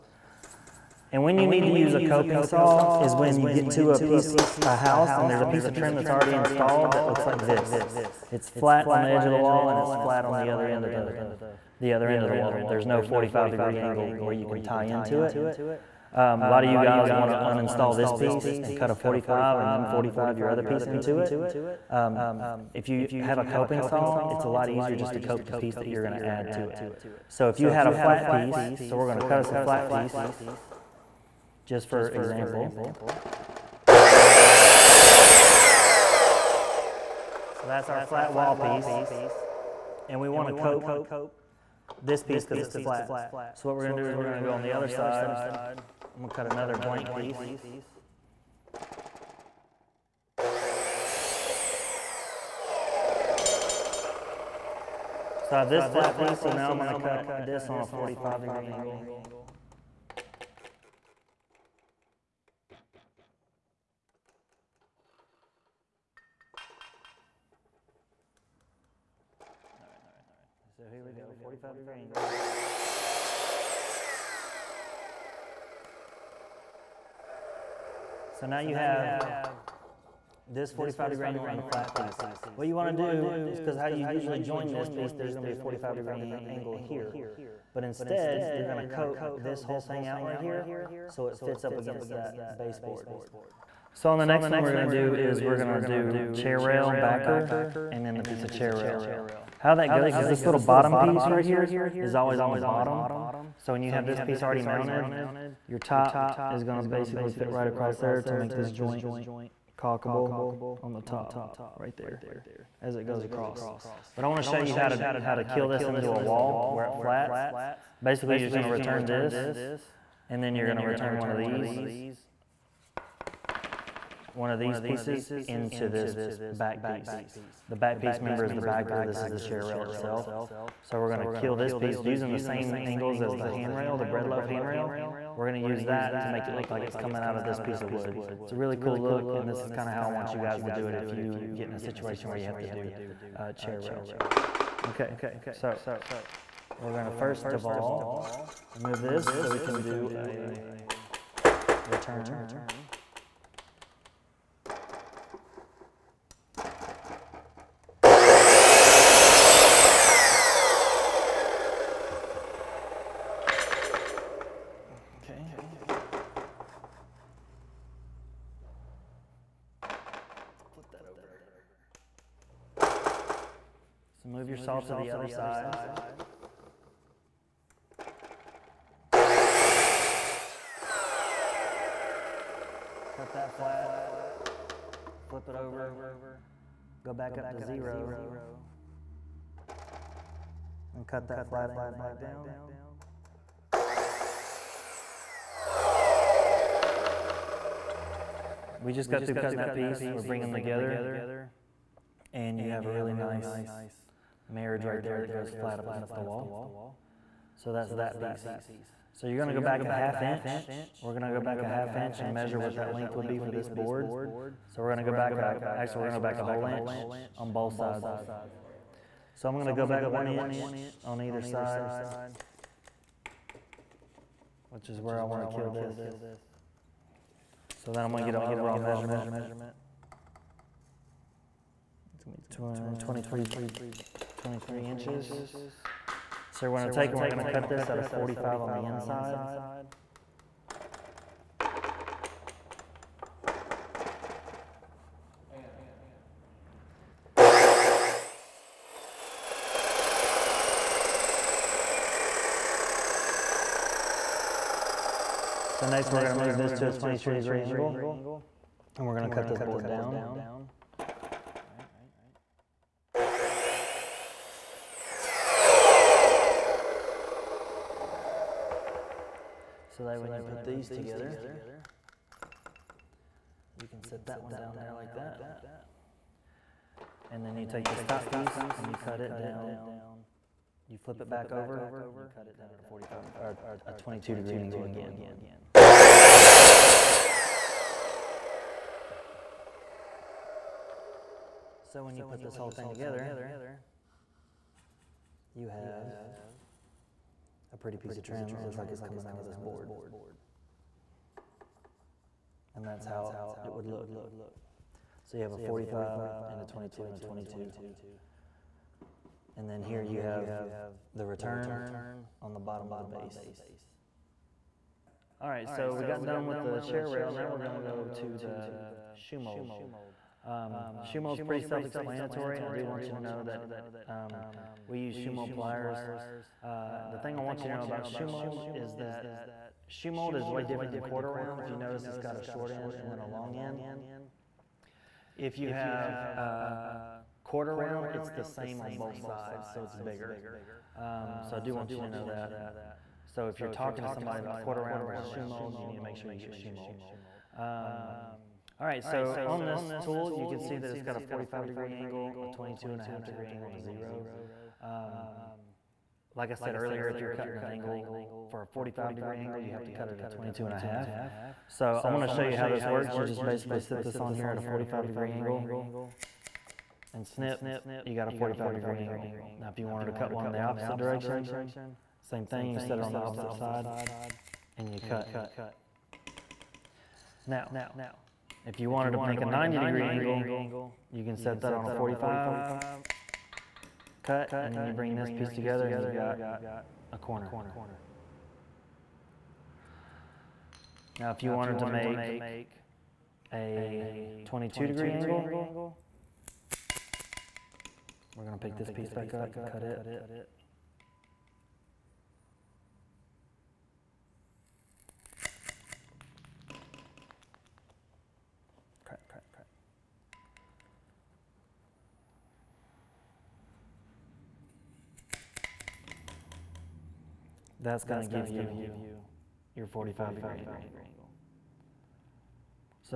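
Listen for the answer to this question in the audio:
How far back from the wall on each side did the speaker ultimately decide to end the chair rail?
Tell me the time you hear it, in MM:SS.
03:40.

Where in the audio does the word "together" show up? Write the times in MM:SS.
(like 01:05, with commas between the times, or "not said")
03:20, 04:30, 04:52, 06:25.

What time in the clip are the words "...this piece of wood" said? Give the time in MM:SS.
02:17.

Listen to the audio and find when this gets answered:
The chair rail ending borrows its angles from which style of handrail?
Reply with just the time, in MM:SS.
02:14.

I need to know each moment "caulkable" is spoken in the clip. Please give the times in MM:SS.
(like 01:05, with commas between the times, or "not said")
01:49.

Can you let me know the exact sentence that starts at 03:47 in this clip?
So then I'm gonna get an overall measurement.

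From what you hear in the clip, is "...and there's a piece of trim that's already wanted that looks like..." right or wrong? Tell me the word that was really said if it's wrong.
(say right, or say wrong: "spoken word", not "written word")
wrong: "installed", not "wanted".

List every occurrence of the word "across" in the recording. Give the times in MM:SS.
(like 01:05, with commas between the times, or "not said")
01:47, 01:53.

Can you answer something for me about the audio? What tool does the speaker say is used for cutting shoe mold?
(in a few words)
shoe mold pliers.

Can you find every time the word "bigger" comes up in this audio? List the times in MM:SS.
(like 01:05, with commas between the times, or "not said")
05:39.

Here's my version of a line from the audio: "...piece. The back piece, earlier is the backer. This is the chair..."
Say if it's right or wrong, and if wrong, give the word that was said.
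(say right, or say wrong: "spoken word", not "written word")
wrong: "member", not "earlier".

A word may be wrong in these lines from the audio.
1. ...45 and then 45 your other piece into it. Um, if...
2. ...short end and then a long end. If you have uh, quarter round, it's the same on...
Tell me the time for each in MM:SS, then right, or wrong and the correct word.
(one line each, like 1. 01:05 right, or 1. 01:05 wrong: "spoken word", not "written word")
1. 00:18 right
2. 05:32 right.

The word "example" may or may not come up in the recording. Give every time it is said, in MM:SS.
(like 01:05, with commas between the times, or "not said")
00:32.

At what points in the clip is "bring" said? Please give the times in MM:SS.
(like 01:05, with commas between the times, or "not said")
03:20, 06:24.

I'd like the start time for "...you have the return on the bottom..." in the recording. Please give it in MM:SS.
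05:10.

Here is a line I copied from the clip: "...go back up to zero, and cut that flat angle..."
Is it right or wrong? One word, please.
right.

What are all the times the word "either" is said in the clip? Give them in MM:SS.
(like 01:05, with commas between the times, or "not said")
03:41.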